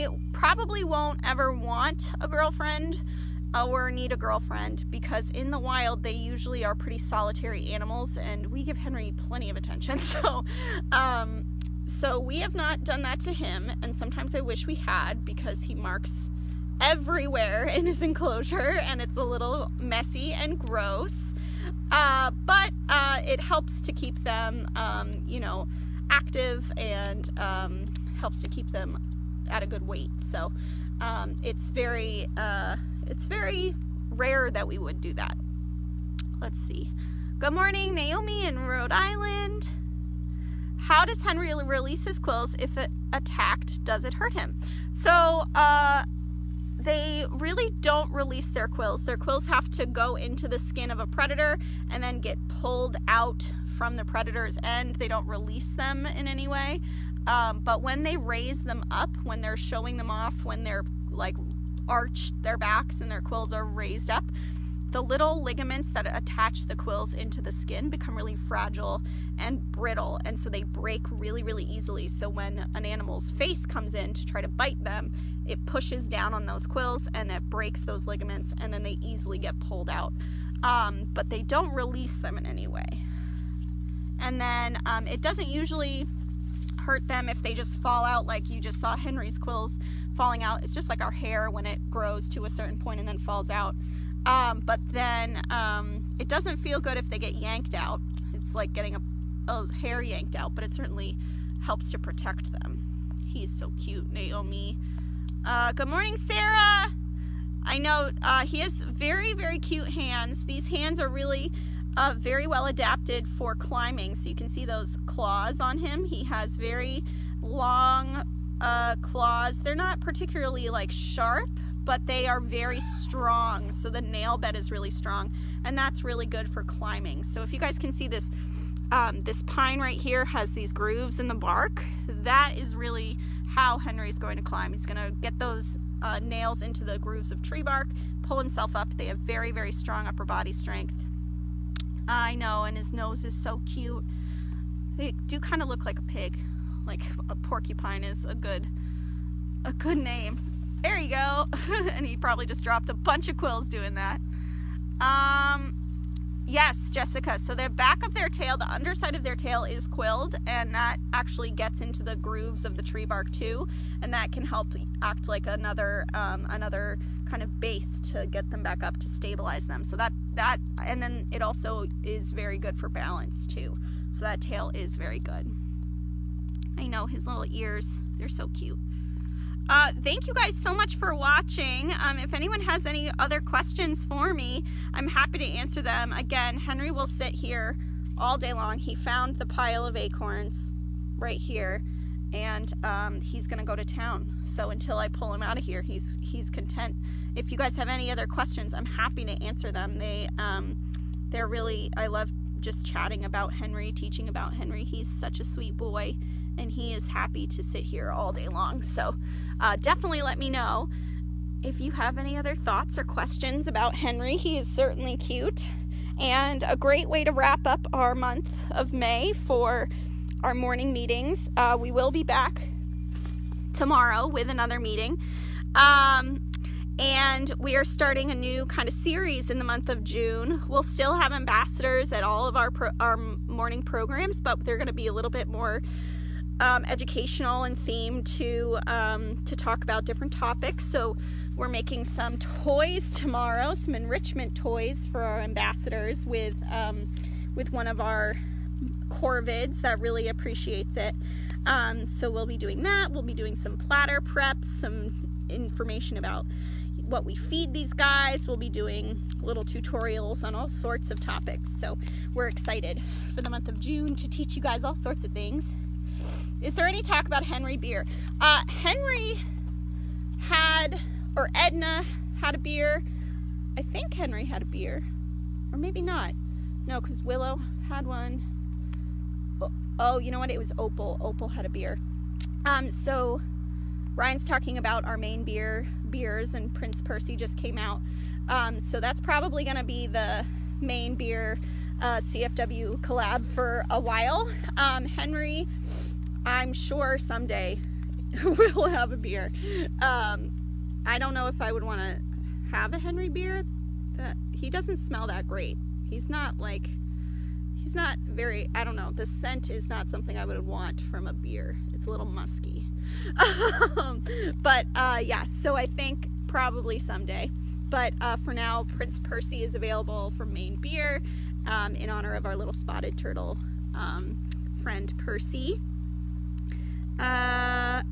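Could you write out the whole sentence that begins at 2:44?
And that can help act like another, um, another kind of base to get them back up to stabilize them.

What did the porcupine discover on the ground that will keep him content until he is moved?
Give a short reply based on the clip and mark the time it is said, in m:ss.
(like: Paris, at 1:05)
acorns, at 3:09.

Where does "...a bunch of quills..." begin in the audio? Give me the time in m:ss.
2:32.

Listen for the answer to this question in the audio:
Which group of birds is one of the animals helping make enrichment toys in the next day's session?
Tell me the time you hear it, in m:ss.
4:09.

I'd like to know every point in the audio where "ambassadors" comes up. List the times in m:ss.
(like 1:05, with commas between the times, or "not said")
3:51, 4:05.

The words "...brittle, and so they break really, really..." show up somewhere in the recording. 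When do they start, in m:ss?
1:09.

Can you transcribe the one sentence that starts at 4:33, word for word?
I think Henry had a beer, or maybe not.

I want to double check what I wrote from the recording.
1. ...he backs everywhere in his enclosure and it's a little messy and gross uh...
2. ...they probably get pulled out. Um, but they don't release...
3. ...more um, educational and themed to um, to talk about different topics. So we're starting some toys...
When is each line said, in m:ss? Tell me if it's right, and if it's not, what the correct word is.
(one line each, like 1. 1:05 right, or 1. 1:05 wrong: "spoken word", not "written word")
1. 0:15 wrong: "marks", not "backs"
2. 1:18 wrong: "easily", not "probably"
3. 3:55 wrong: "making", not "starting".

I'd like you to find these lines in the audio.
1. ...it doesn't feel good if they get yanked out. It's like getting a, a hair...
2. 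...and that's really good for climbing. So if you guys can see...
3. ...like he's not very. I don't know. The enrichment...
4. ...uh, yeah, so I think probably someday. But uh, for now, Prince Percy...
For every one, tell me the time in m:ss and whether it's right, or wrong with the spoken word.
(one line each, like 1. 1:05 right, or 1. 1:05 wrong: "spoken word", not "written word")
1. 1:36 right
2. 2:05 right
3. 5:06 wrong: "scent", not "enrichment"
4. 5:14 right.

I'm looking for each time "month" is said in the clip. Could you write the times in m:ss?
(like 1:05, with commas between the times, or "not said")
3:38, 3:49, 4:23.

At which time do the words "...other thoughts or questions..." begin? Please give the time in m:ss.
3:32.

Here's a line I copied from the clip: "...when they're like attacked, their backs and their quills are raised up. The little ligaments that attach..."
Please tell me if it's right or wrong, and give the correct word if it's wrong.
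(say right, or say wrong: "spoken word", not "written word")
wrong: "arched", not "attacked".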